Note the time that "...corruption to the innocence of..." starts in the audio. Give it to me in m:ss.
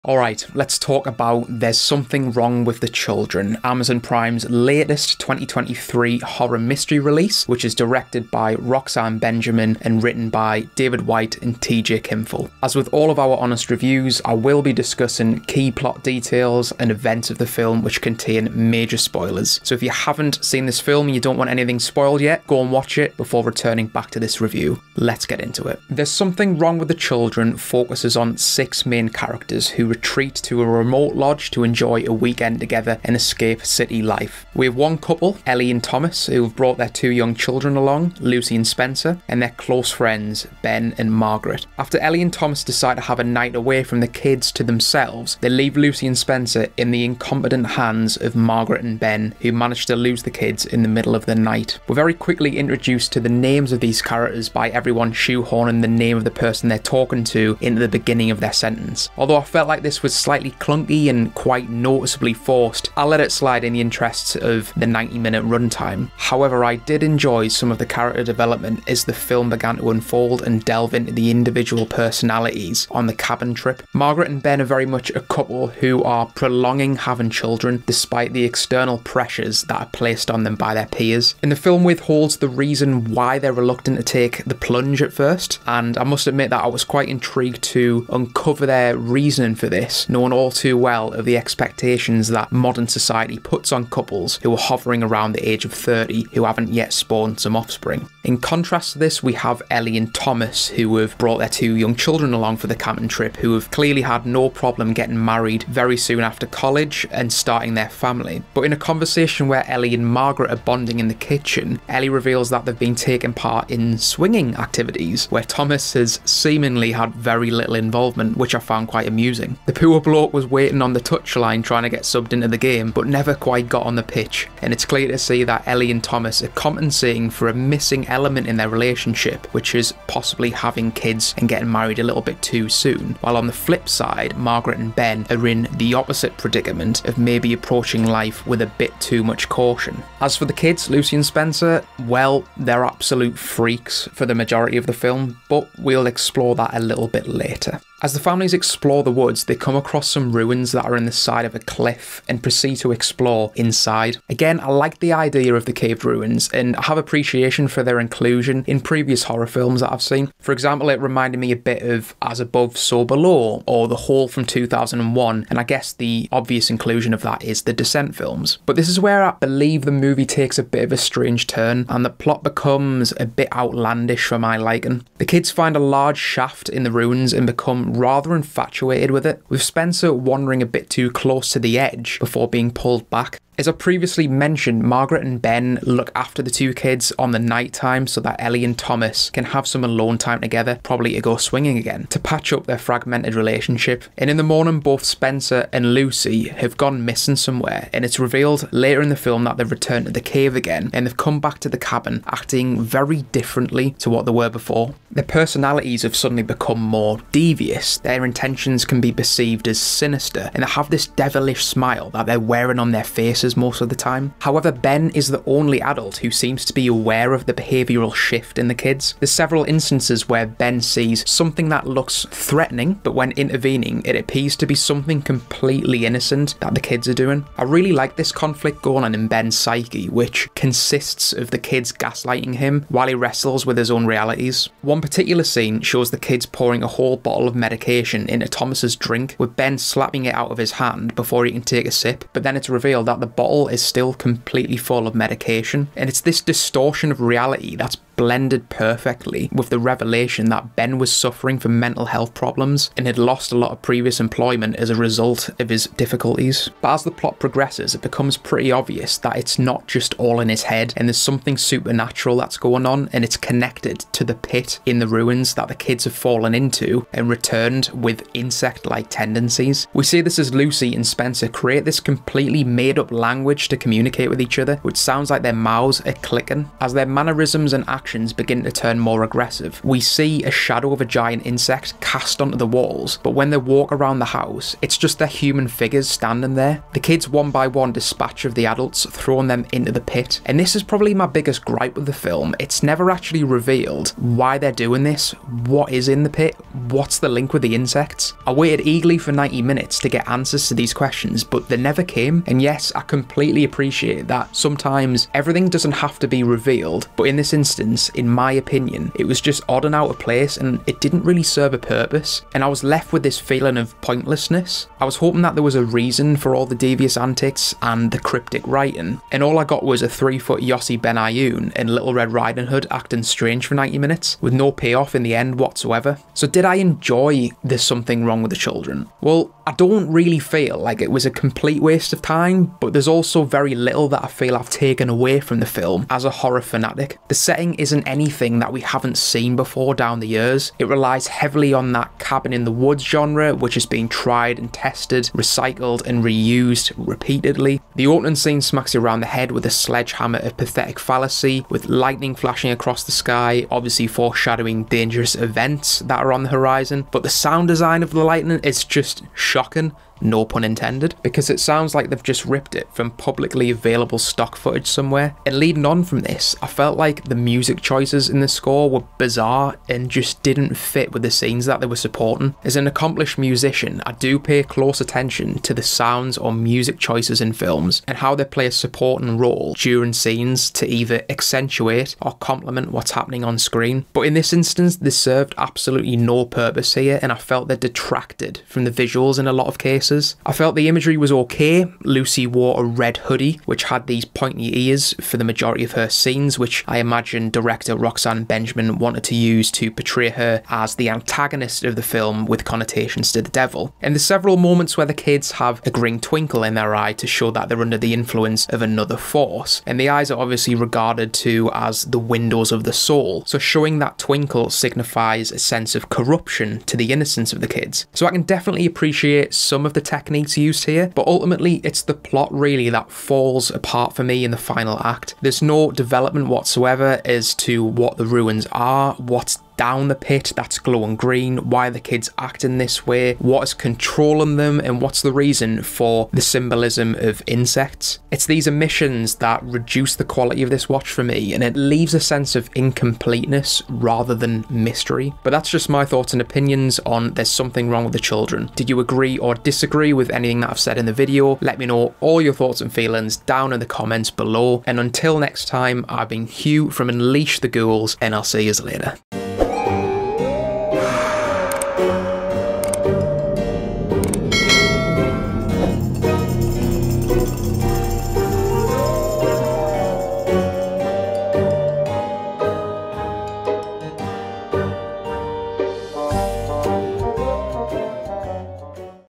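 6:56.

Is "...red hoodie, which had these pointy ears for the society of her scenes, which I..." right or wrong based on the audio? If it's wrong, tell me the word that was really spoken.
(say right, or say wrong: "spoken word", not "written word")
wrong: "majority", not "society".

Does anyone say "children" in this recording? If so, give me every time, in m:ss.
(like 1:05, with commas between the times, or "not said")
0:02, 0:26, 0:37, 1:17, 1:41, 5:28, 7:28.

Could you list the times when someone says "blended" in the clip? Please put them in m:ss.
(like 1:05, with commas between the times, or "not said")
4:08.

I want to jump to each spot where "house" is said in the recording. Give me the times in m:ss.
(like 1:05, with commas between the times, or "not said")
4:44.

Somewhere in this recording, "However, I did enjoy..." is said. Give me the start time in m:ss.
1:06.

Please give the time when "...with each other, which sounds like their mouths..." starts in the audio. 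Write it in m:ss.
4:34.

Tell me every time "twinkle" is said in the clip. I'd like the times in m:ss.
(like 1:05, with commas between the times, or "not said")
6:46, 6:54.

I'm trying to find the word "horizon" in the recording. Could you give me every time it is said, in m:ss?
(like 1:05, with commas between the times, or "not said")
5:56.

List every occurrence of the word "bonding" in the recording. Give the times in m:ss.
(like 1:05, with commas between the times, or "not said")
1:50.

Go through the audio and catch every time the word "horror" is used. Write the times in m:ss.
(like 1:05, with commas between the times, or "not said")
0:06, 2:39, 5:36.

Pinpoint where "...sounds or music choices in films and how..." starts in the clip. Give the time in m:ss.
6:15.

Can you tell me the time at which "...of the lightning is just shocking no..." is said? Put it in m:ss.
5:58.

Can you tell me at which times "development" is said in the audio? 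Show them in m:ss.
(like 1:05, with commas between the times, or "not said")
1:08, 7:05.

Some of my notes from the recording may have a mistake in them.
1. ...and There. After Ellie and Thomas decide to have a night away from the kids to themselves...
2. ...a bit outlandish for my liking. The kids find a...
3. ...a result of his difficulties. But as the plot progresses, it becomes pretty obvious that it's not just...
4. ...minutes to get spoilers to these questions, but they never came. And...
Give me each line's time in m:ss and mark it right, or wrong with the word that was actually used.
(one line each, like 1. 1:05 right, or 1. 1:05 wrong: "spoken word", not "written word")
1. 0:40 wrong: "Margaret", not "There"
2. 2:53 right
3. 4:14 right
4. 4:59 wrong: "answers", not "spoilers".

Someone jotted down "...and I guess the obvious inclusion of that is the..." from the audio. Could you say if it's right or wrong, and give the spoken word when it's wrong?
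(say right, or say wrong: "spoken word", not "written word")
right.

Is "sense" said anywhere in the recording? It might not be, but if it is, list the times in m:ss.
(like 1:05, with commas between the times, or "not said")
6:55, 7:22.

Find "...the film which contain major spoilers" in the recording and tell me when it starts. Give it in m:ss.
0:17.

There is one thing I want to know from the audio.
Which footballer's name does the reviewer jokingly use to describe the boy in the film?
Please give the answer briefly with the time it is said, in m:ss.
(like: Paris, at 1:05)
Yossi Benayoun, at 5:20.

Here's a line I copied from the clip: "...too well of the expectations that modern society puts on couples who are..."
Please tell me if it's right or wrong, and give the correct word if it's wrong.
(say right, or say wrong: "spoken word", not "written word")
right.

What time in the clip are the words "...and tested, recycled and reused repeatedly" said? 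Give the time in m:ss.
5:44.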